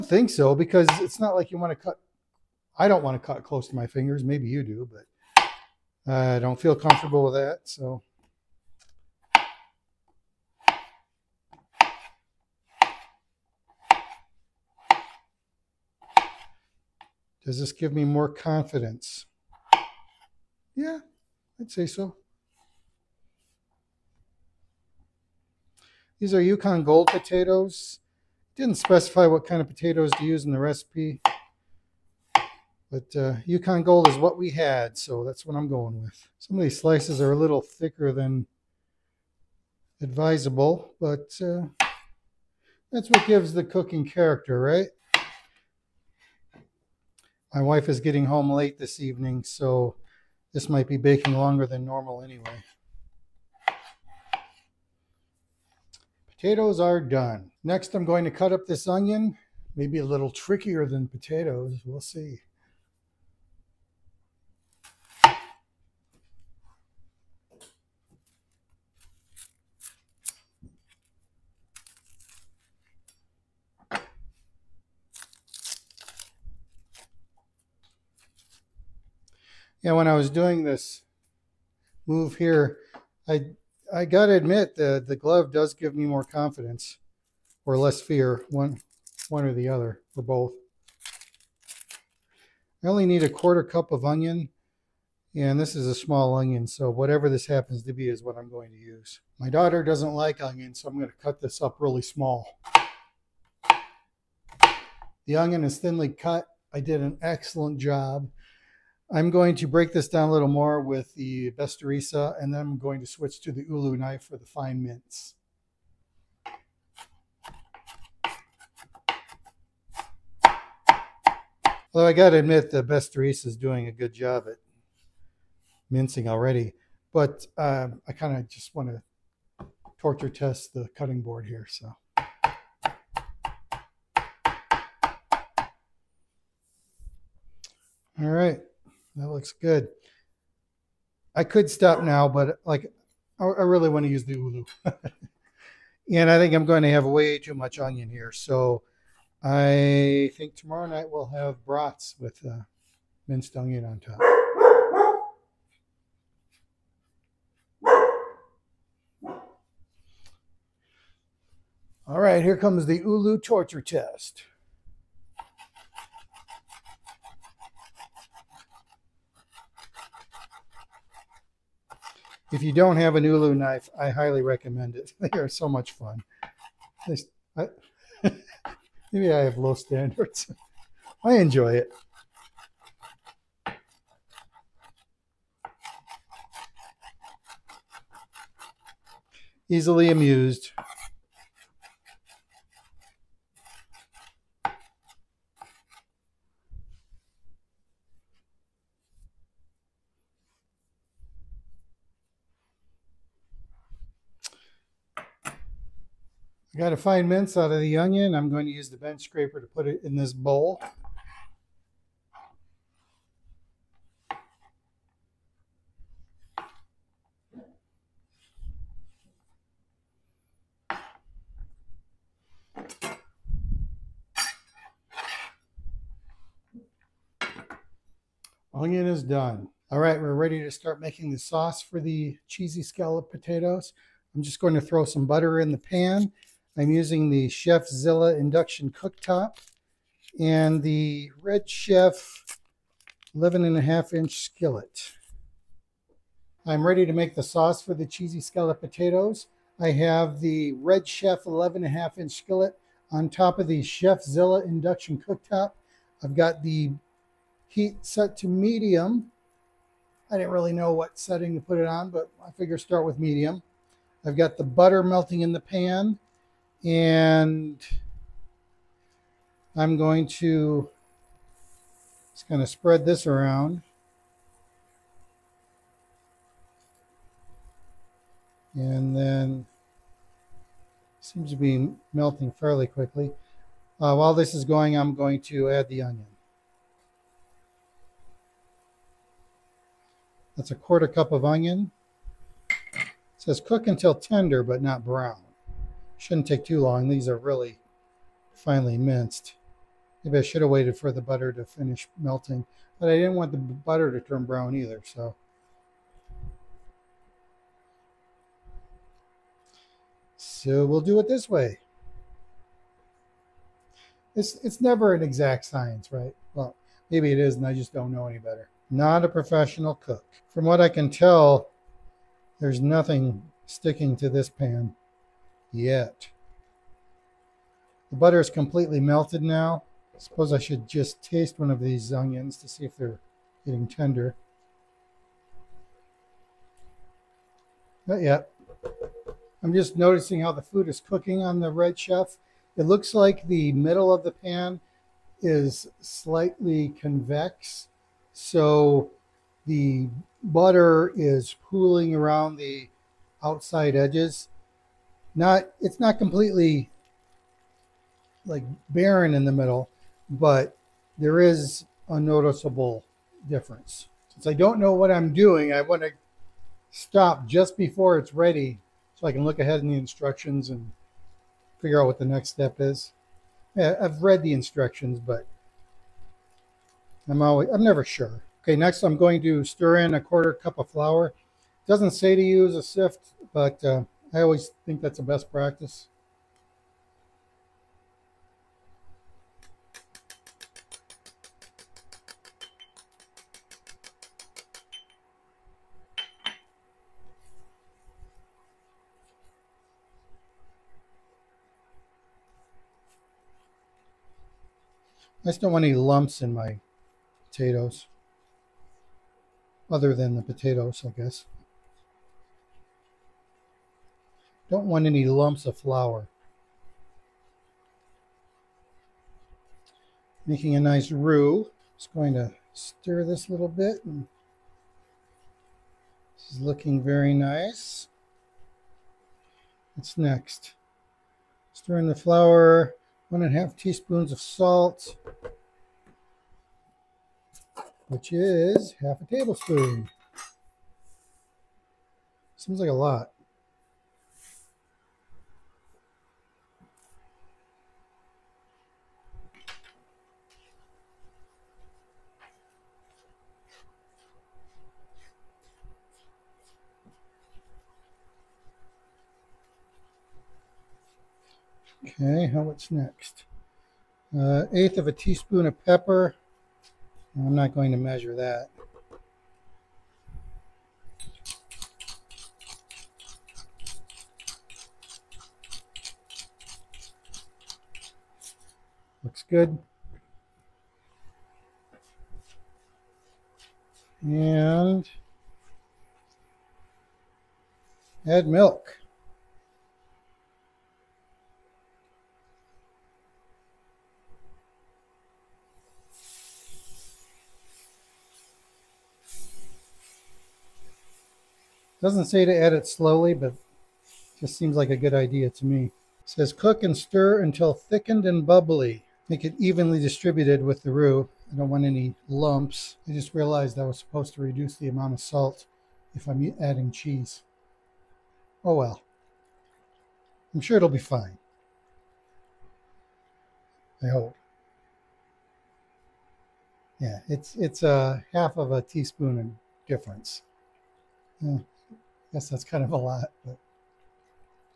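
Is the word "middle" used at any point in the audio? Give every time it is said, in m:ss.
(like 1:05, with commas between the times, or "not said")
5:43, 5:59.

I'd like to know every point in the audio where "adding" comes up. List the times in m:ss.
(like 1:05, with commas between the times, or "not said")
8:36.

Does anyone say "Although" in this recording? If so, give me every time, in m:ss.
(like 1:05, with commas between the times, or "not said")
2:01.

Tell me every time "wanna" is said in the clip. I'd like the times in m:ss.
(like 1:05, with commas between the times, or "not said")
not said.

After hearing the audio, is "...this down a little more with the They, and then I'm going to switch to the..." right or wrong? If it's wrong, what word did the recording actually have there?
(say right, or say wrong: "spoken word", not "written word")
wrong: "Bestarisa", not "They".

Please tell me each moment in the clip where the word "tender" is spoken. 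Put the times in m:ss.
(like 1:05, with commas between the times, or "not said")
4:54, 5:33.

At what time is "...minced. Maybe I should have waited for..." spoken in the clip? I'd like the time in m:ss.
4:58.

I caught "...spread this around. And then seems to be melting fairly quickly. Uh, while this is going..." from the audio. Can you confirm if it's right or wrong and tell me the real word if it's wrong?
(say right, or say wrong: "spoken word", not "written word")
right.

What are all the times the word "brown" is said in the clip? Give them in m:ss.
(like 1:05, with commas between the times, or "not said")
4:55, 5:04.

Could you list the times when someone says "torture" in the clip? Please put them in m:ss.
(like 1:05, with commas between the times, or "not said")
2:09, 2:43.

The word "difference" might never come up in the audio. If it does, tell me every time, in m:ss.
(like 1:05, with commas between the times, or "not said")
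6:03, 8:49.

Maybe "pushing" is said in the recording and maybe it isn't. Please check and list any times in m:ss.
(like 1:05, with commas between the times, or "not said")
not said.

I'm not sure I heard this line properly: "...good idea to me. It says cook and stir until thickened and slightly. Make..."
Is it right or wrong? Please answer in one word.
wrong.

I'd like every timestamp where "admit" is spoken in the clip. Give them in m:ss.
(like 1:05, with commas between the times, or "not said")
1:24, 2:02.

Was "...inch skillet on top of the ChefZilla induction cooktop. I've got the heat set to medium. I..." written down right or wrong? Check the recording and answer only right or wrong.
right.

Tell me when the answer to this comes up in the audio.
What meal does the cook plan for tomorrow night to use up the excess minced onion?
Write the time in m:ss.
2:31.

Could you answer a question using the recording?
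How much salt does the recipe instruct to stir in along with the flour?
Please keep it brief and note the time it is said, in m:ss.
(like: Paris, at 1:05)
1.5 teaspoons, at 7:13.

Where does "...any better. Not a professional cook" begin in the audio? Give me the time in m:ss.
5:18.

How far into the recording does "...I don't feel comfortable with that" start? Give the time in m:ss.
0:06.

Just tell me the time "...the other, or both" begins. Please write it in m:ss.
1:29.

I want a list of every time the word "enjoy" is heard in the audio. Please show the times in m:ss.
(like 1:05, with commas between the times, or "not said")
3:01.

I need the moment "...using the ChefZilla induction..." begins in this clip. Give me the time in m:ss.
3:56.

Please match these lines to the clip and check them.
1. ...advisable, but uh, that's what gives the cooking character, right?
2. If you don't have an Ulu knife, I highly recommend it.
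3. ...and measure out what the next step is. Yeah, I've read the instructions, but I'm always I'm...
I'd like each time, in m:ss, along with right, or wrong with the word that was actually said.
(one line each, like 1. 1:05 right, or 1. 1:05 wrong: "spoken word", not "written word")
1. 0:40 right
2. 2:52 right
3. 6:10 wrong: "figure", not "measure".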